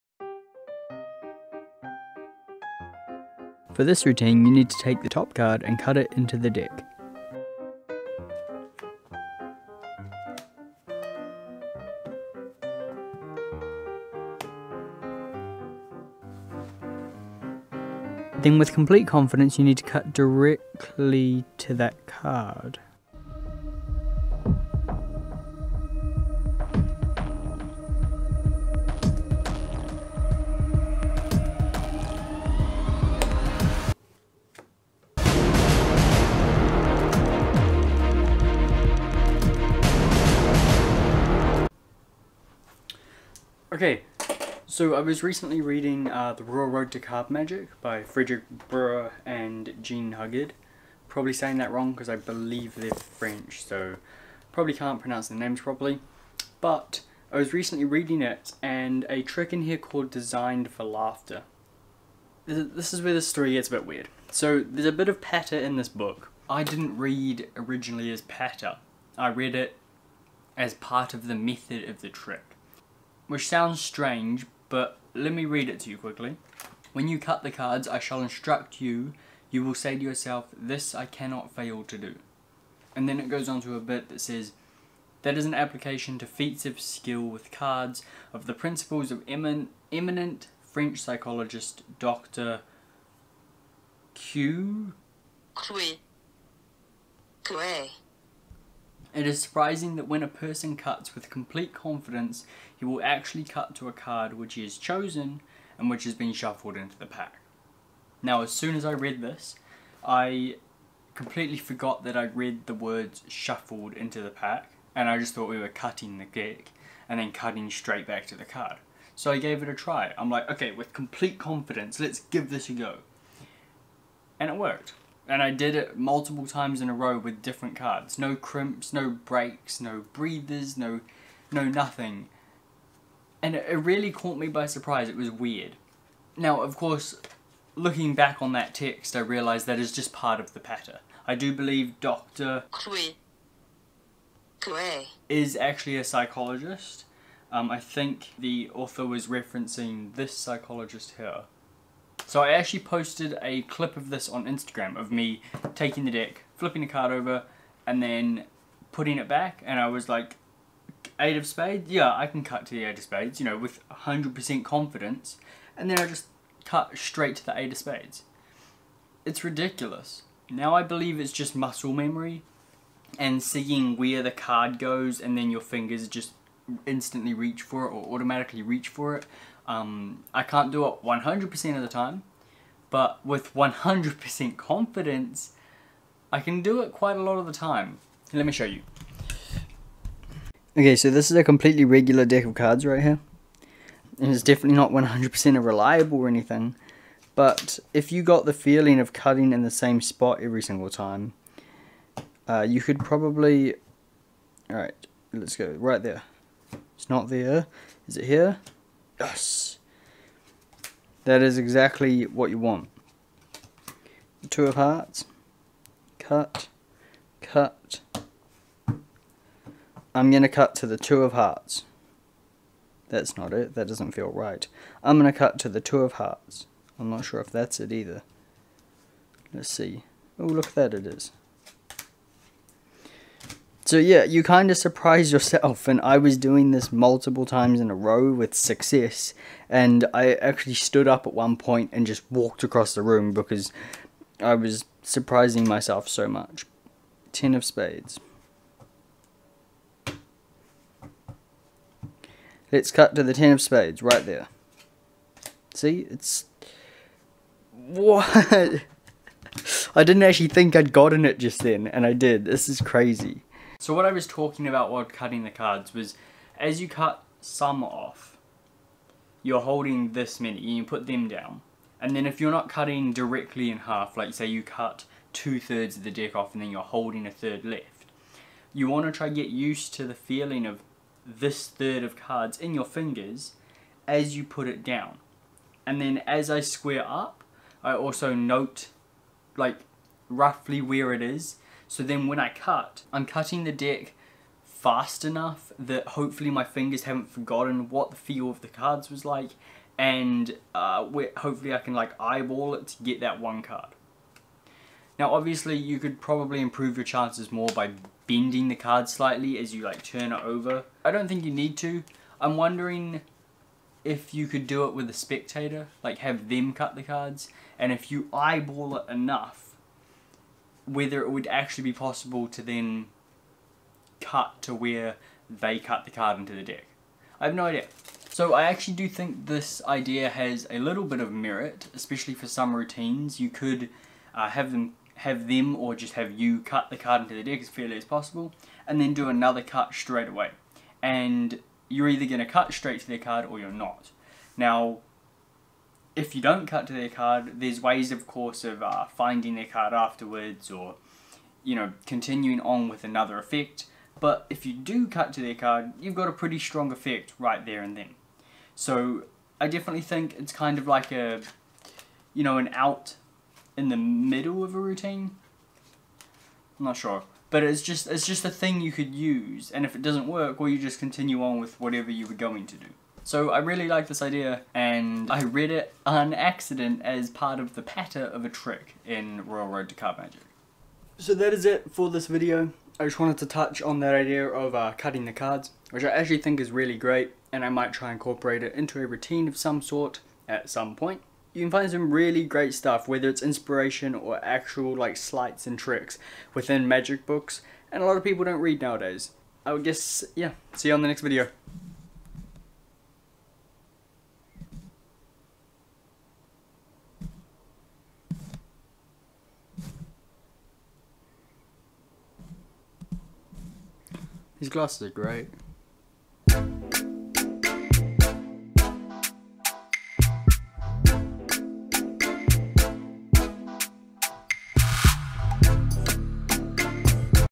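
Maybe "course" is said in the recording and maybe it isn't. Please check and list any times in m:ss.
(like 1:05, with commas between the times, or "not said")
2:16, 5:48.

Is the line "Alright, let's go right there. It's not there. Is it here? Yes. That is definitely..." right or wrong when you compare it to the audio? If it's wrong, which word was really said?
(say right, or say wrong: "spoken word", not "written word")
wrong: "exactly", not "definitely".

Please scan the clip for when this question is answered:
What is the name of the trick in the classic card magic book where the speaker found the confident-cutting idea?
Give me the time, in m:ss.
1:00.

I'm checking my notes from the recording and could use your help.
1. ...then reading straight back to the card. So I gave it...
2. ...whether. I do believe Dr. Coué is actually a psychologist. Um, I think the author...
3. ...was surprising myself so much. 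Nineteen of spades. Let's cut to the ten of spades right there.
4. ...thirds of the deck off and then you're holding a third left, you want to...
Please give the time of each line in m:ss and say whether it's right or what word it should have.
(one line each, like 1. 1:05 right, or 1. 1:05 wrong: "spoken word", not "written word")
1. 1:57 wrong: "cutting", not "reading"
2. 2:20 wrong: "patter", not "whether"
3. 4:04 wrong: "Ten", not "Nineteen"
4. 4:35 right.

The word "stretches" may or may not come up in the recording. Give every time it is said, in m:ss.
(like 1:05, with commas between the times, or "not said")
not said.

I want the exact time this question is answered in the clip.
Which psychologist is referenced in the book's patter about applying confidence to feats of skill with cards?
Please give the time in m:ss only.
1:31.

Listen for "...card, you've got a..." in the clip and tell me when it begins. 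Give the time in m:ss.
5:55.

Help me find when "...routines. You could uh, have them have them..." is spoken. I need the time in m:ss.
5:32.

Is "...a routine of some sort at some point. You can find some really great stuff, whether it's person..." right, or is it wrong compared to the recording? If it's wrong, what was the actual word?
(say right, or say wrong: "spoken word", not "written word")
wrong: "inspiration", not "person".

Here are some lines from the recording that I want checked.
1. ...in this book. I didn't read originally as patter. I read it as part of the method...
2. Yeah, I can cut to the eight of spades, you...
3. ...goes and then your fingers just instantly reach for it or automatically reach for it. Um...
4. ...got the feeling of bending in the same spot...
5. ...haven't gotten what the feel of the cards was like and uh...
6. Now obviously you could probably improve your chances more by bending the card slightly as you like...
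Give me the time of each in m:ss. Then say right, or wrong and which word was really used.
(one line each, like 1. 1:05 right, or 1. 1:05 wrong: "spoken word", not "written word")
1. 1:05 right
2. 2:41 right
3. 2:54 right
4. 3:18 wrong: "cutting", not "bending"
5. 4:57 wrong: "forgotten", not "gotten"
6. 5:05 right.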